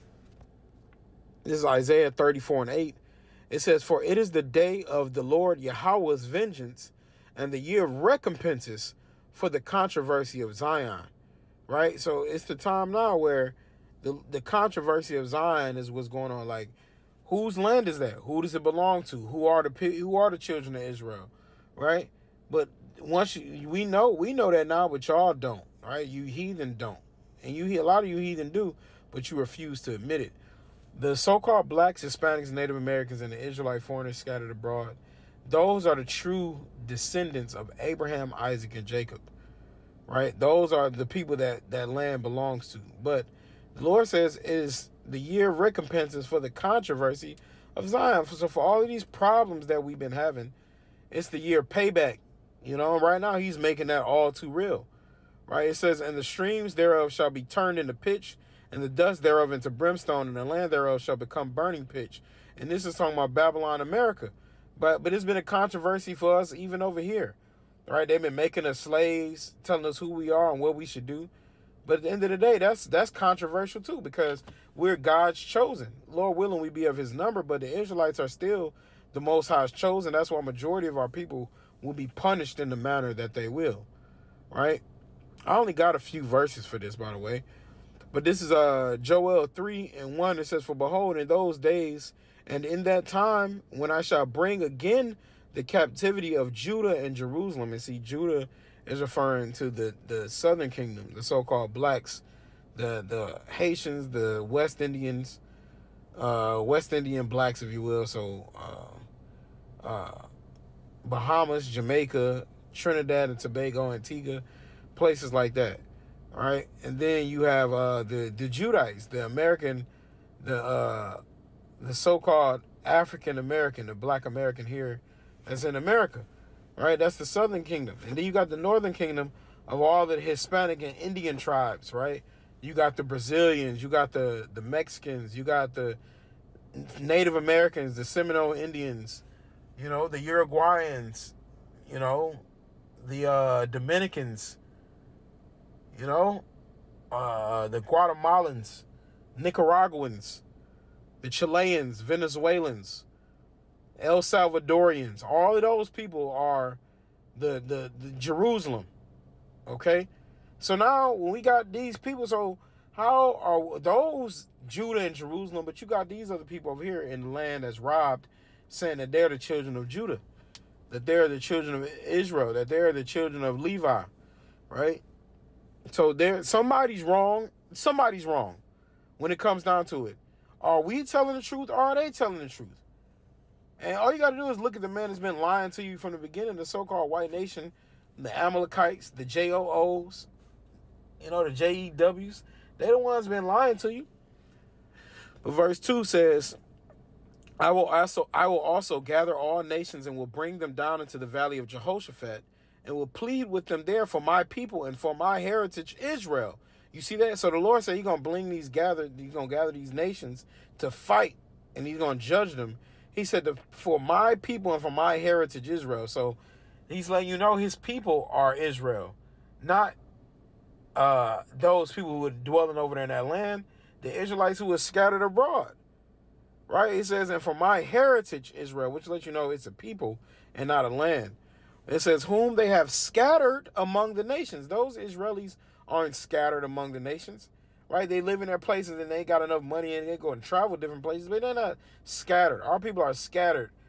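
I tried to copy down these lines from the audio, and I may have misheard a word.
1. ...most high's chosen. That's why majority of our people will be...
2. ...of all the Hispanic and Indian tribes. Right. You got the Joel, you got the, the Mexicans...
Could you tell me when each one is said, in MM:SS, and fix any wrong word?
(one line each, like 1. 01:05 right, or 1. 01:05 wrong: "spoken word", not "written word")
1. 01:19 right
2. 02:09 wrong: "Brazilians", not "Joel".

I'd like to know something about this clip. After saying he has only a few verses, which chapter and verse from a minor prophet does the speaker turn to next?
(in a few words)
Joel 3:1.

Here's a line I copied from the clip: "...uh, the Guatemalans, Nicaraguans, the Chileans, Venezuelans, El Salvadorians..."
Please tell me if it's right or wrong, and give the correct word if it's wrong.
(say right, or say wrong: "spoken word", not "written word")
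right.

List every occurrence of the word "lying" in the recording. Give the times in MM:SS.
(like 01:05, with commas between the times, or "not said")
03:05, 03:13.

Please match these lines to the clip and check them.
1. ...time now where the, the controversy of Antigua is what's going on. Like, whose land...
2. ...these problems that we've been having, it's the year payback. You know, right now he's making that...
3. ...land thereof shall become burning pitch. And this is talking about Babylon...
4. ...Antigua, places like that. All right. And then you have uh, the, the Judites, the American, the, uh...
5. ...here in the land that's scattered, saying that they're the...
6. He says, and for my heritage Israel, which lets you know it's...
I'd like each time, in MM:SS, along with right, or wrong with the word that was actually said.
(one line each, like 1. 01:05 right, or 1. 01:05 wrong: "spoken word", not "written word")
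1. 00:12 wrong: "Zion", not "Antigua"
2. 00:48 right
3. 01:00 right
4. 01:53 right
5. 02:46 wrong: "robbed", not "scattered"
6. 03:46 right.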